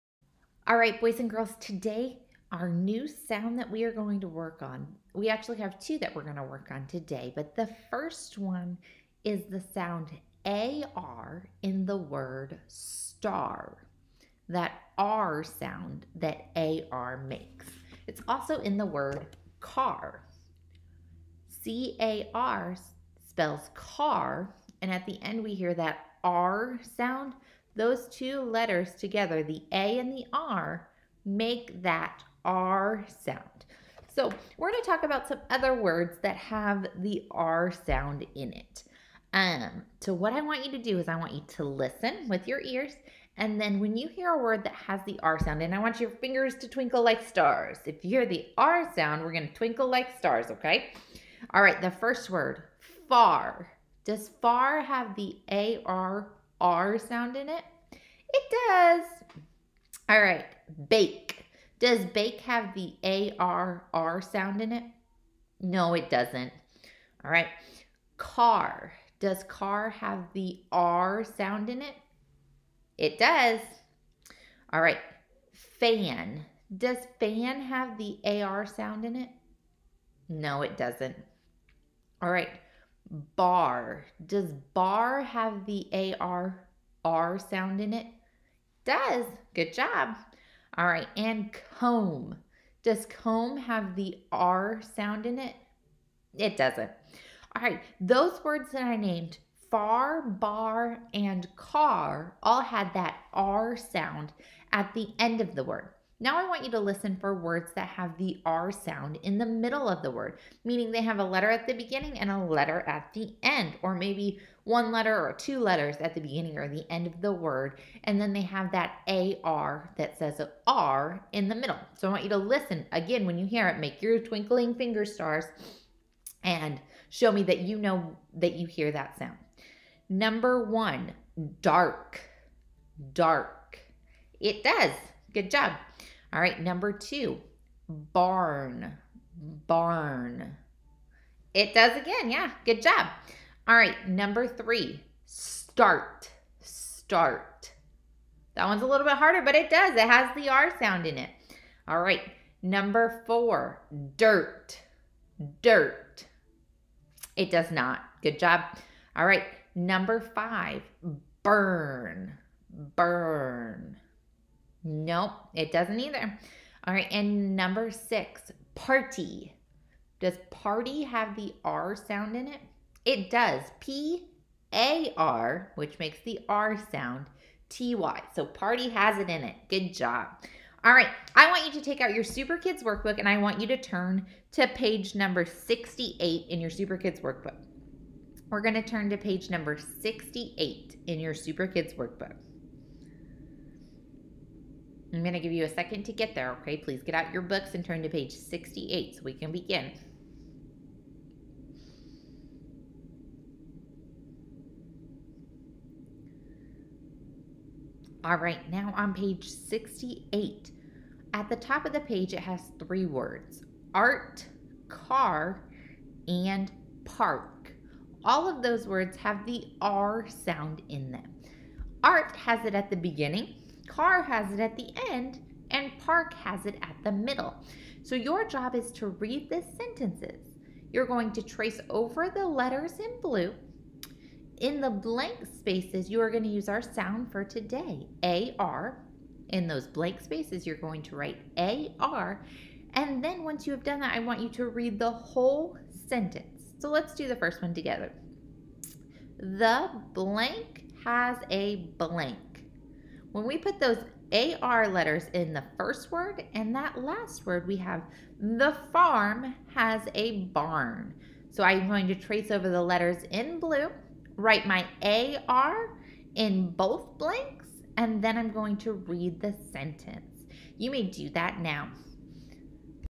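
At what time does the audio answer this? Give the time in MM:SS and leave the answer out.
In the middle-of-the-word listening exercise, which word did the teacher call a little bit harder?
02:25.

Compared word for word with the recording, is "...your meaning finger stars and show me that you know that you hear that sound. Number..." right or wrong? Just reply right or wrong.
wrong.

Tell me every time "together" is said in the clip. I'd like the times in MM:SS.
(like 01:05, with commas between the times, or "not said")
00:28, 04:07.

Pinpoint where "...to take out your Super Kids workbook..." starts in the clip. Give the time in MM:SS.
03:01.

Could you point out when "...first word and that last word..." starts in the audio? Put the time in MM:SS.
04:15.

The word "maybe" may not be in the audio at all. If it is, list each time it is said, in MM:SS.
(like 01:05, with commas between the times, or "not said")
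01:53.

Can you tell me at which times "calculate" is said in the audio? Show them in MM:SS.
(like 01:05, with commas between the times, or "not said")
not said.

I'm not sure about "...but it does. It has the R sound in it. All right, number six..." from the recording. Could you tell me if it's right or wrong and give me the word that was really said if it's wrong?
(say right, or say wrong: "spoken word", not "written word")
wrong: "four", not "six".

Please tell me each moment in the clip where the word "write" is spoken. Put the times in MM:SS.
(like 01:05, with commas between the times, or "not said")
04:01, 04:24.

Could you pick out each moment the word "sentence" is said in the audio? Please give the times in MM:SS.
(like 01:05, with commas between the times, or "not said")
03:49, 04:06, 04:29.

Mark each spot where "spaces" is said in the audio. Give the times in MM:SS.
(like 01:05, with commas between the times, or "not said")
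03:55, 04:00.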